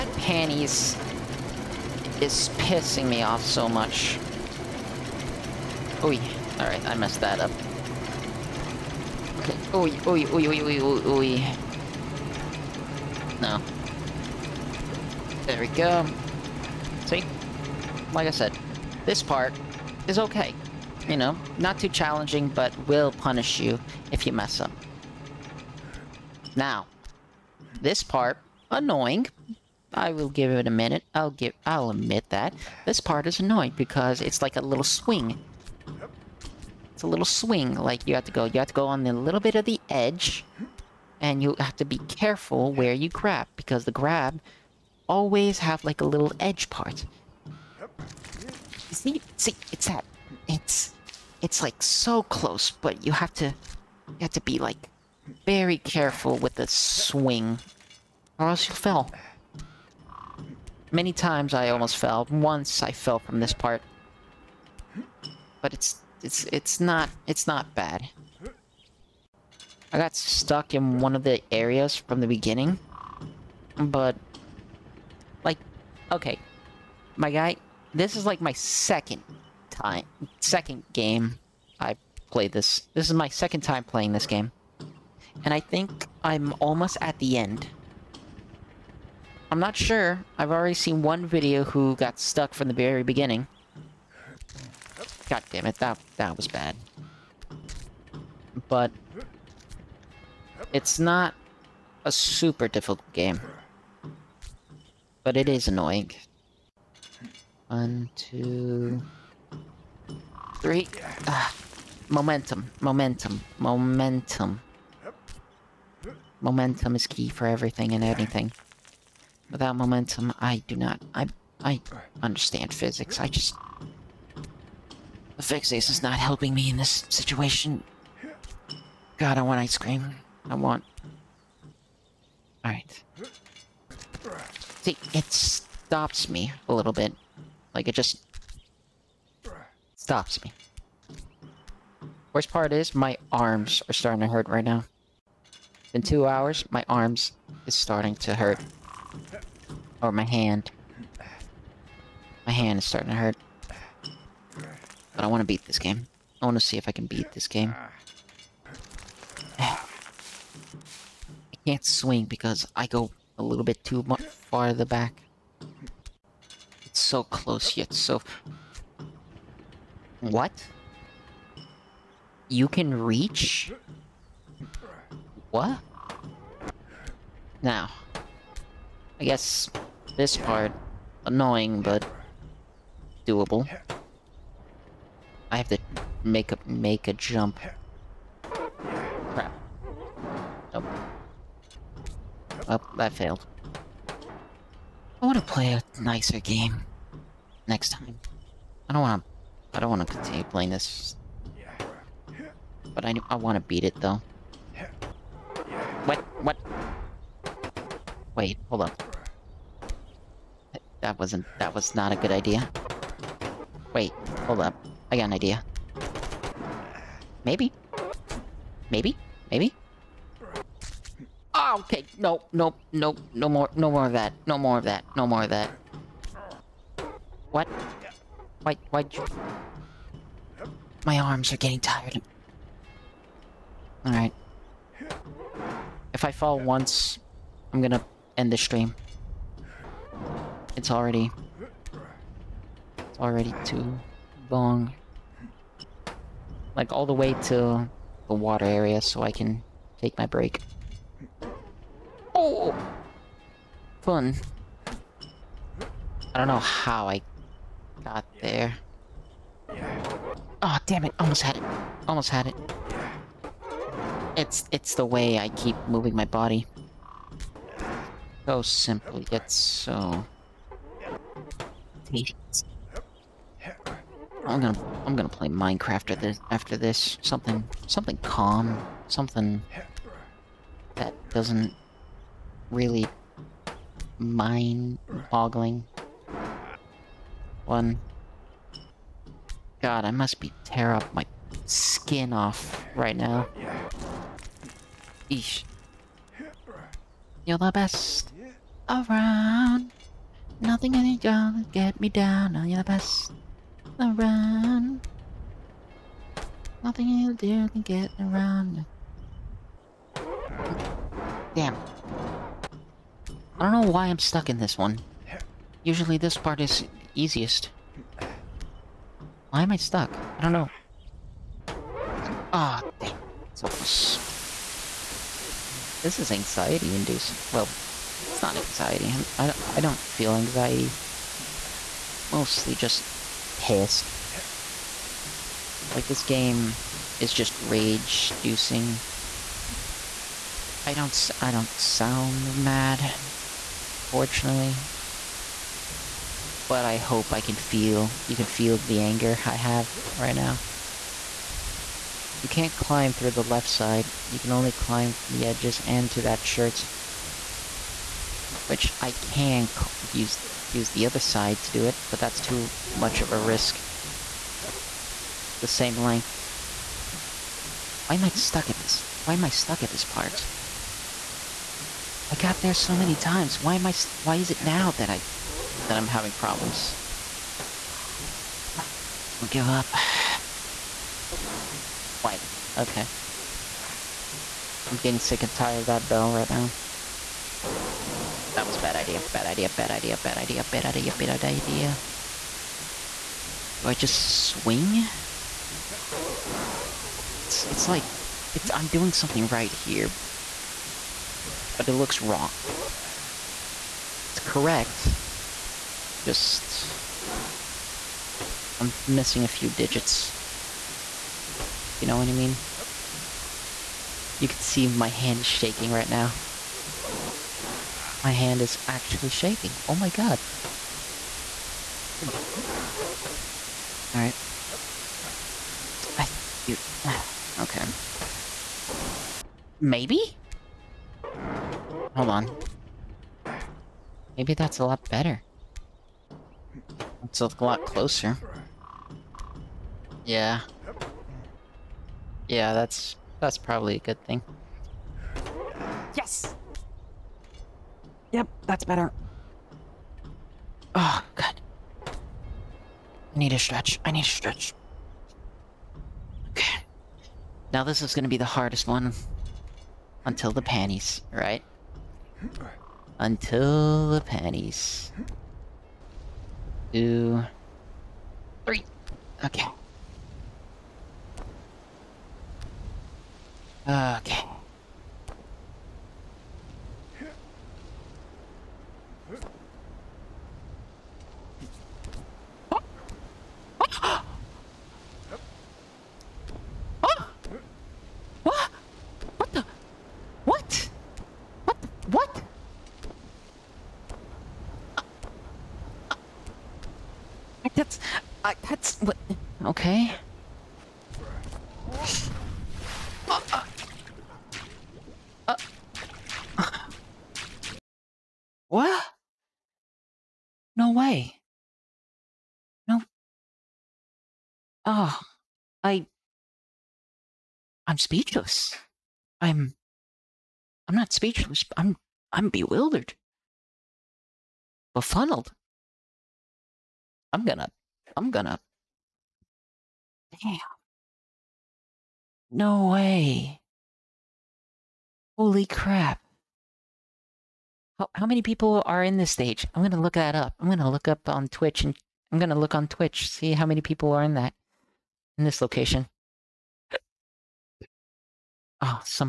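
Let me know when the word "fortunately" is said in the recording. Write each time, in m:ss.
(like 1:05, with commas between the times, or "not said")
5:44.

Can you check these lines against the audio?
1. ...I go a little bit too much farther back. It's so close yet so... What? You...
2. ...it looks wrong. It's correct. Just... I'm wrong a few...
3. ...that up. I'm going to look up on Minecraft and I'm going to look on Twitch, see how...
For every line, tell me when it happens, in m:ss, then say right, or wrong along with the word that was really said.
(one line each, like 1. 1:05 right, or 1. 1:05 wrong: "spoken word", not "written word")
1. 2:42 right
2. 6:41 wrong: "missing", not "wrong"
3. 9:00 wrong: "Twitch", not "Minecraft".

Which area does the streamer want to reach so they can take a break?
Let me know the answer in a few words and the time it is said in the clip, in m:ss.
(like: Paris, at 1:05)
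The water area, at 4:08.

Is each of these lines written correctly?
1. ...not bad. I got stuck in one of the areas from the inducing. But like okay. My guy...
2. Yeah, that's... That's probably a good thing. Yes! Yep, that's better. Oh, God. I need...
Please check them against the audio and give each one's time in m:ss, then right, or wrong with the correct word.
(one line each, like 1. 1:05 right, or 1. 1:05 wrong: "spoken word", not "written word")
1. 1:07 wrong: "beginning", not "inducing"
2. 7:22 right.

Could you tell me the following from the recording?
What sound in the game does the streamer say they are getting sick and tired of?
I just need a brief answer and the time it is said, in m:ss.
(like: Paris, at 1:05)
Bell, at 6:25.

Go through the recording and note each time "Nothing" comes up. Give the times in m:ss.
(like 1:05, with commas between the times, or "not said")
5:00, 5:06.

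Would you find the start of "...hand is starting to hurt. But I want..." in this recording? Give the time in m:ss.
2:32.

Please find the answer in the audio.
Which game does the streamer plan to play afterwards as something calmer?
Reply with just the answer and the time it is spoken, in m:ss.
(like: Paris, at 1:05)
Minecraft, at 4:35.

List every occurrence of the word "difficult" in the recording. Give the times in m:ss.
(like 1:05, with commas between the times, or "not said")
1:42.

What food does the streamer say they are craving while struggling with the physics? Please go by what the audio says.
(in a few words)
Ice cream.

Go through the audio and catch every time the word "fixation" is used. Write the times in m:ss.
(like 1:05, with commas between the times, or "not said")
2:05.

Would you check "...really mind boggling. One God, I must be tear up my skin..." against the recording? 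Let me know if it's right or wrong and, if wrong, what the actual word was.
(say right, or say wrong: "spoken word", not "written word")
right.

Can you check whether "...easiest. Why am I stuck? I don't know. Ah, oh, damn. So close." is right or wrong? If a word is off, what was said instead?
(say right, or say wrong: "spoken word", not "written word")
right.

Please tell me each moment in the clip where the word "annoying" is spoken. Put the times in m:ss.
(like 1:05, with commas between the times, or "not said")
0:28, 0:33, 1:45, 3:01.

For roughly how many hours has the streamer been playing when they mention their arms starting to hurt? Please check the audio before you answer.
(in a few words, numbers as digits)
2.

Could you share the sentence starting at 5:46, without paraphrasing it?
But I hope I can feel, you can feel the anger I have right now.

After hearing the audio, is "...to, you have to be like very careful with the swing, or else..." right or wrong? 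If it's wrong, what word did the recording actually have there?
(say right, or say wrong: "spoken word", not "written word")
right.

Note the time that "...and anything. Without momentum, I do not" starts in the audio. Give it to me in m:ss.
1:57.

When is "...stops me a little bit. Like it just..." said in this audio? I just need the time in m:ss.
2:15.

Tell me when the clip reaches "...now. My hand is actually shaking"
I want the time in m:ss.
6:56.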